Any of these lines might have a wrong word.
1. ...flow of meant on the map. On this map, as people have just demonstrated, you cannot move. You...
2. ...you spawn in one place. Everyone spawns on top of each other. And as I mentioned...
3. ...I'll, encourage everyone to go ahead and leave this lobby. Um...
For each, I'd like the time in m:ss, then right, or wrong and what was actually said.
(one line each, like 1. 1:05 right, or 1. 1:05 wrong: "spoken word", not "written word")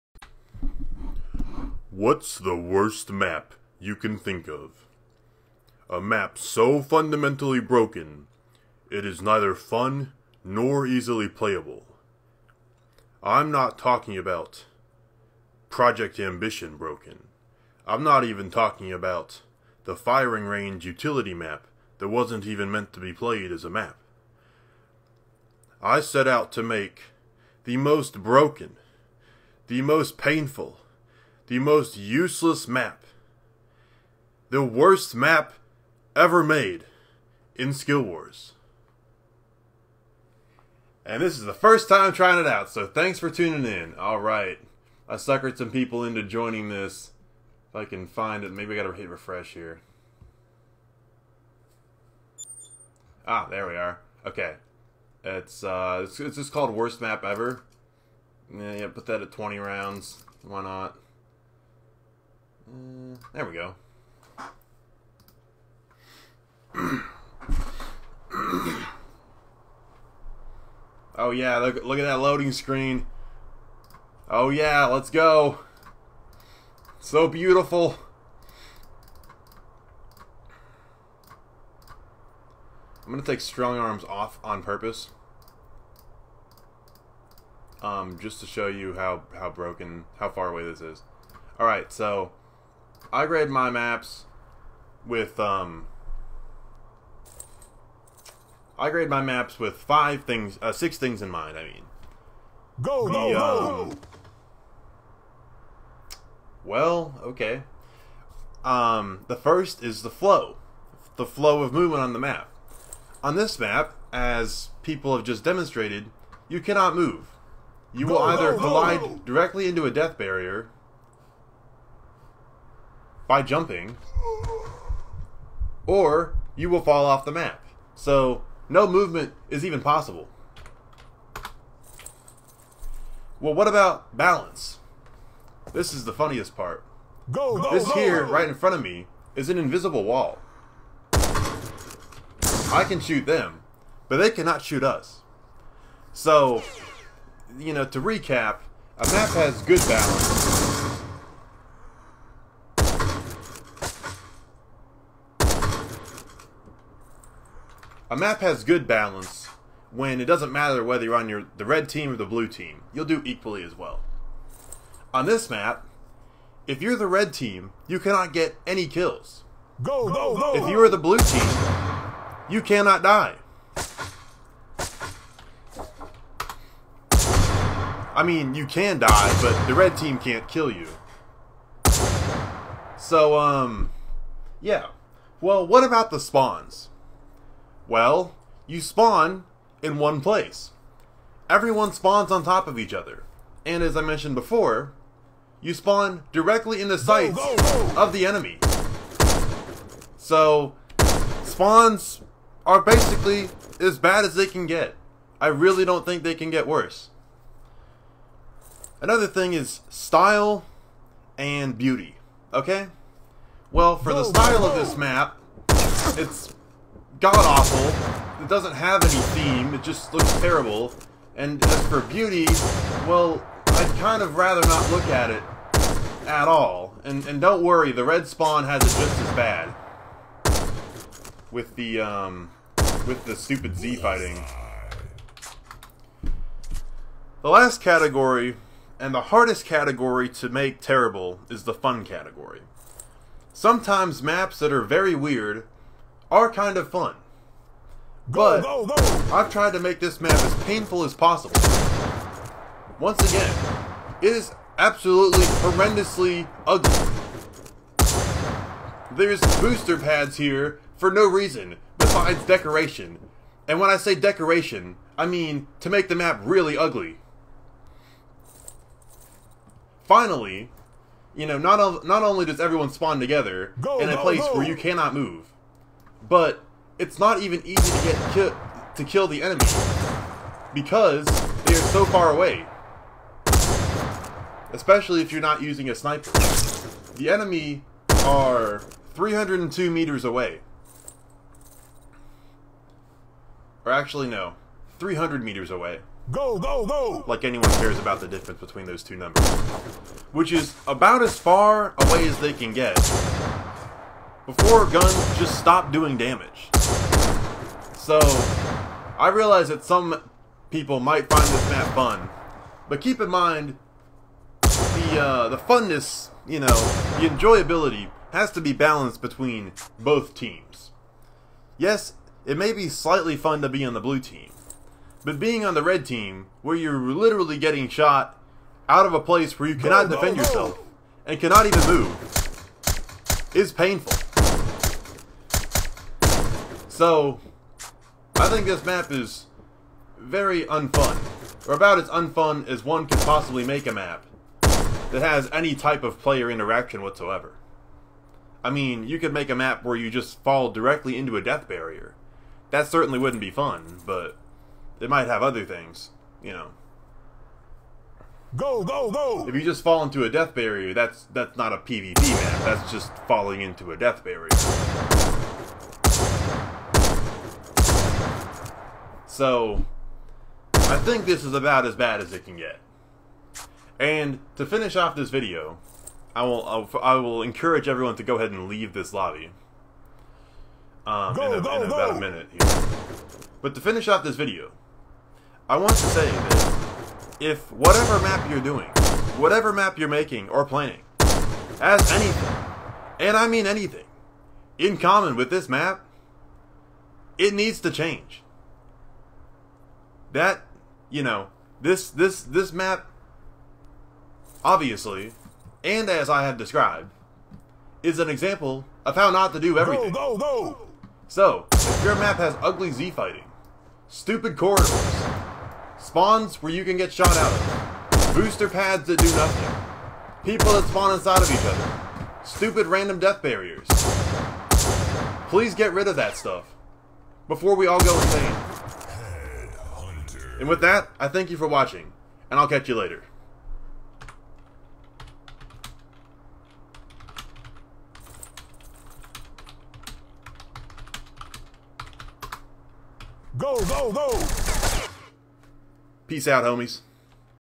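1. 1:51 wrong: "movement", not "meant"
2. 3:08 right
3. 6:17 right.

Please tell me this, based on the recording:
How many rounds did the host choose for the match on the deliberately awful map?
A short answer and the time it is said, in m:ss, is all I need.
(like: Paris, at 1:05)
20, at 0:59.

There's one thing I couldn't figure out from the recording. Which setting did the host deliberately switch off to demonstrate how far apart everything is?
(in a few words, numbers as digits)
strong arms.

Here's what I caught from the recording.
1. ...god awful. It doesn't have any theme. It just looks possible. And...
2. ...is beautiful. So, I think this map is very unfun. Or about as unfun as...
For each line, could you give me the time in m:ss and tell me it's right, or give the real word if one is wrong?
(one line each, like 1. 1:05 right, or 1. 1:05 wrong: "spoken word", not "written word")
1. 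3:37 wrong: "terrible", not "possible"
2. 5:33 wrong: "painful", not "beautiful".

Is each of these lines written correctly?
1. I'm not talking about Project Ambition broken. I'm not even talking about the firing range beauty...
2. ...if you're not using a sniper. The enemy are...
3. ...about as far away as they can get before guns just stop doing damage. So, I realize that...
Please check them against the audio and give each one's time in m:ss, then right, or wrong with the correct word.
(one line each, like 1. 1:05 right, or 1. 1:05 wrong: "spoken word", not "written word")
1. 0:13 wrong: "utility", not "beauty"
2. 4:45 right
3. 5:00 right.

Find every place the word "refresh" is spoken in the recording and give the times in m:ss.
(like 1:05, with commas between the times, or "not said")
0:49.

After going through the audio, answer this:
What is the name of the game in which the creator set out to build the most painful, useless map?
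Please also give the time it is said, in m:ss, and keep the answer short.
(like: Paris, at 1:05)
SkillWarz, at 0:37.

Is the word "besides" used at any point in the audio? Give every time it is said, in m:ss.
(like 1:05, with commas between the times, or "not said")
4:21.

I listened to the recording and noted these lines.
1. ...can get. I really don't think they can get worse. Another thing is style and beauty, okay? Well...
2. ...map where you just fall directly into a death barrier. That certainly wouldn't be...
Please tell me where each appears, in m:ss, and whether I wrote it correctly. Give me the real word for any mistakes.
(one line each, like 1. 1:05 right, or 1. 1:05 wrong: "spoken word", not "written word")
1. 3:24 right
2. 5:49 right.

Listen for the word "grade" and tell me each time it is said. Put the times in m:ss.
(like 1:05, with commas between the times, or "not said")
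1:33, 1:38.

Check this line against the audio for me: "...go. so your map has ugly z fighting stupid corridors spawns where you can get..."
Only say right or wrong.
right.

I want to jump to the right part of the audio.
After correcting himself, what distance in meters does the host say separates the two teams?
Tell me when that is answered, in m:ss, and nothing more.
4:54.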